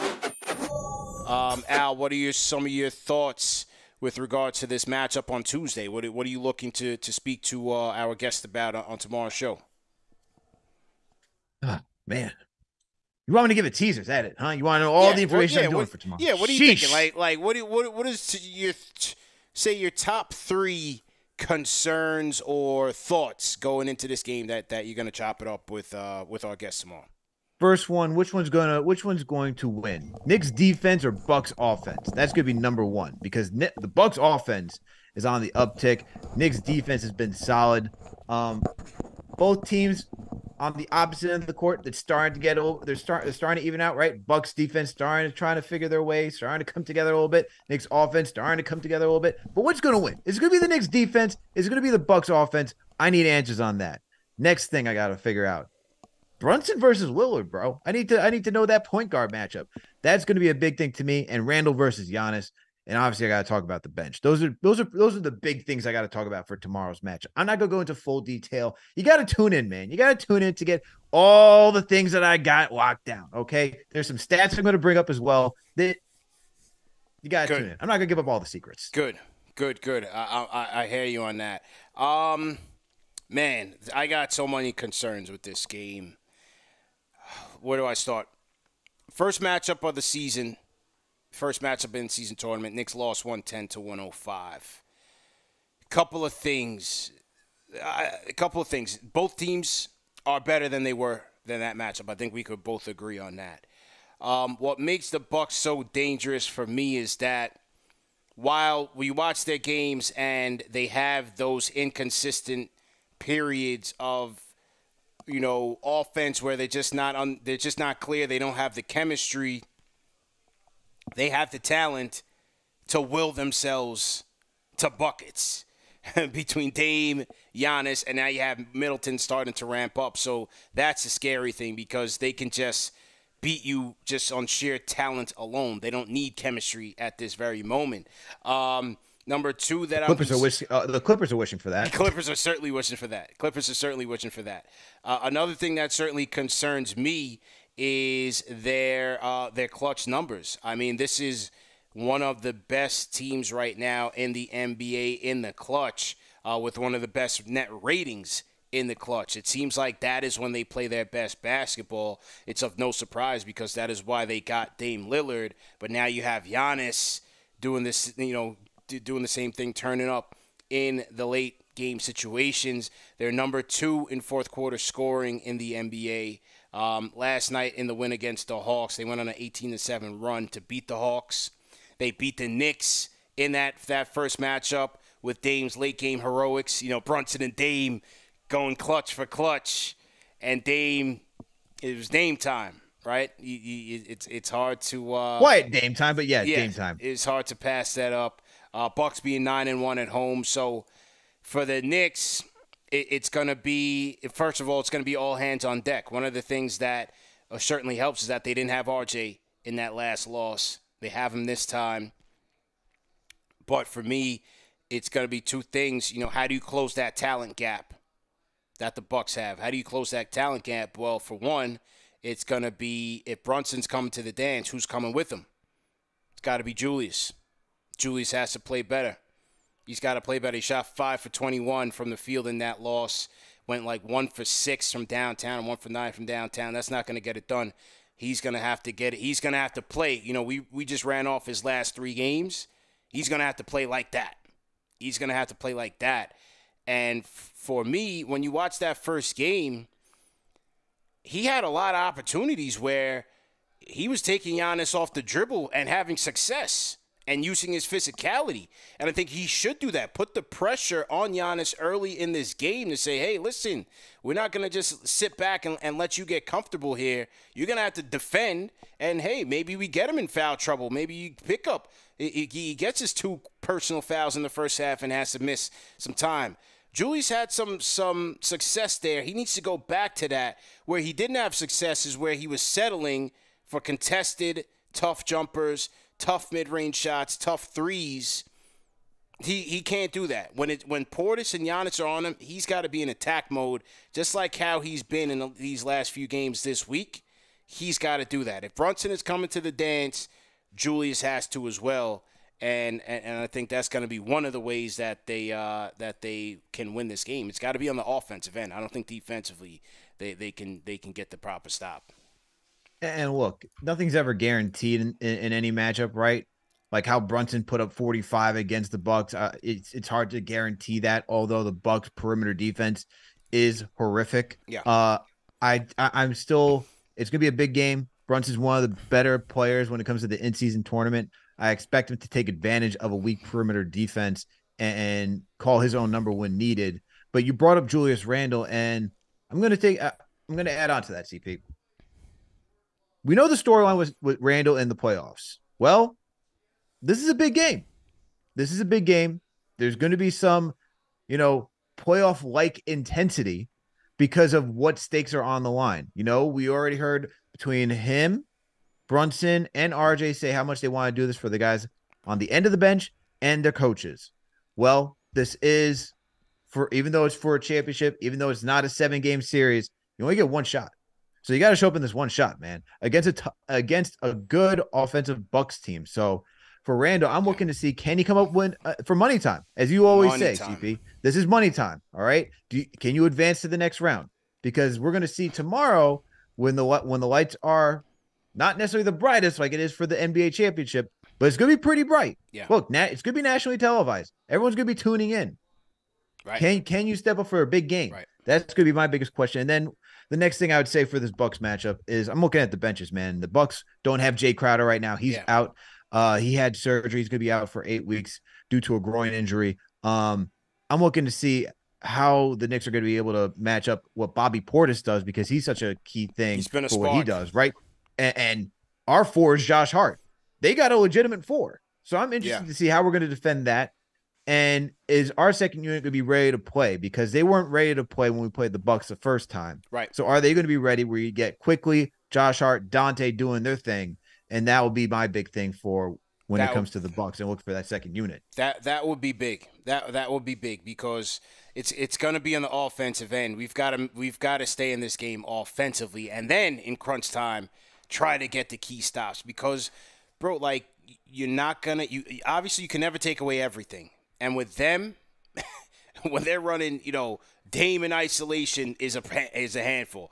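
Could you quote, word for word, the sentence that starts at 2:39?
It seems like that is when they play their best basketball.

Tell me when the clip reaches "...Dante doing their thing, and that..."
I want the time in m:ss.
7:12.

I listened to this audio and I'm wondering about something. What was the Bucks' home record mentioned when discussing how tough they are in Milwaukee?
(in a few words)
9-1.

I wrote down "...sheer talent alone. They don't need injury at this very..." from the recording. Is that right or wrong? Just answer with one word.
wrong.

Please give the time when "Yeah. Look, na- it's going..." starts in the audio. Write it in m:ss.
6:32.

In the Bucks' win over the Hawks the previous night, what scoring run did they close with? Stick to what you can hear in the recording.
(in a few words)
18-7.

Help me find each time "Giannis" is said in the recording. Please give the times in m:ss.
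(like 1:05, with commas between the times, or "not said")
1:02, 2:07, 2:46, 4:14, 4:21, 4:51.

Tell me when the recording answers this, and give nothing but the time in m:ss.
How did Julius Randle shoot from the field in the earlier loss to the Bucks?
3:50.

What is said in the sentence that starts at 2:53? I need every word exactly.
They're number two in fourth quarter scoring in the NBA.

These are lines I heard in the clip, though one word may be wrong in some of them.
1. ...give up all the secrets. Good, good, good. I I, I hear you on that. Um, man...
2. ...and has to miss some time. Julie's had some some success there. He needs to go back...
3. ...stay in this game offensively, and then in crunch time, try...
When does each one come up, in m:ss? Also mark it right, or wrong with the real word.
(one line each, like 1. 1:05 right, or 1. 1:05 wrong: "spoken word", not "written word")
1. 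1:18 right
2. 4:35 right
3. 7:24 right.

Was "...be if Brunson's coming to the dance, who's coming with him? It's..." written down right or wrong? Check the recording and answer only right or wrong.
right.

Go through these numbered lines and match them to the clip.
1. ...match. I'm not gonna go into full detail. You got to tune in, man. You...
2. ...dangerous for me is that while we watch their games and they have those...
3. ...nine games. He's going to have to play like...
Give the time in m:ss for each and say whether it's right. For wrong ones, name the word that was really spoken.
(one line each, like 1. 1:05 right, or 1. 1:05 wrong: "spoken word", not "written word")
1. 1:07 right
2. 1:45 right
3. 4:01 wrong: "three", not "nine".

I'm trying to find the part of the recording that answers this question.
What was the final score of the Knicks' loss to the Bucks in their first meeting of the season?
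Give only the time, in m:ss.
1:33.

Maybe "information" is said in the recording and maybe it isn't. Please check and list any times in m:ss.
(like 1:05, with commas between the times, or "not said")
0:15.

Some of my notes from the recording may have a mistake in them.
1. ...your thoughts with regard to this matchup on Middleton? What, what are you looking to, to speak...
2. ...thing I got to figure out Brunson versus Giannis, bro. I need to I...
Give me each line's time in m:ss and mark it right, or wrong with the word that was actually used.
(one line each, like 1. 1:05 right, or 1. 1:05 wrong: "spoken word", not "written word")
1. 0:02 wrong: "Tuesday", not "Middleton"
2. 0:54 wrong: "Lillard", not "Giannis".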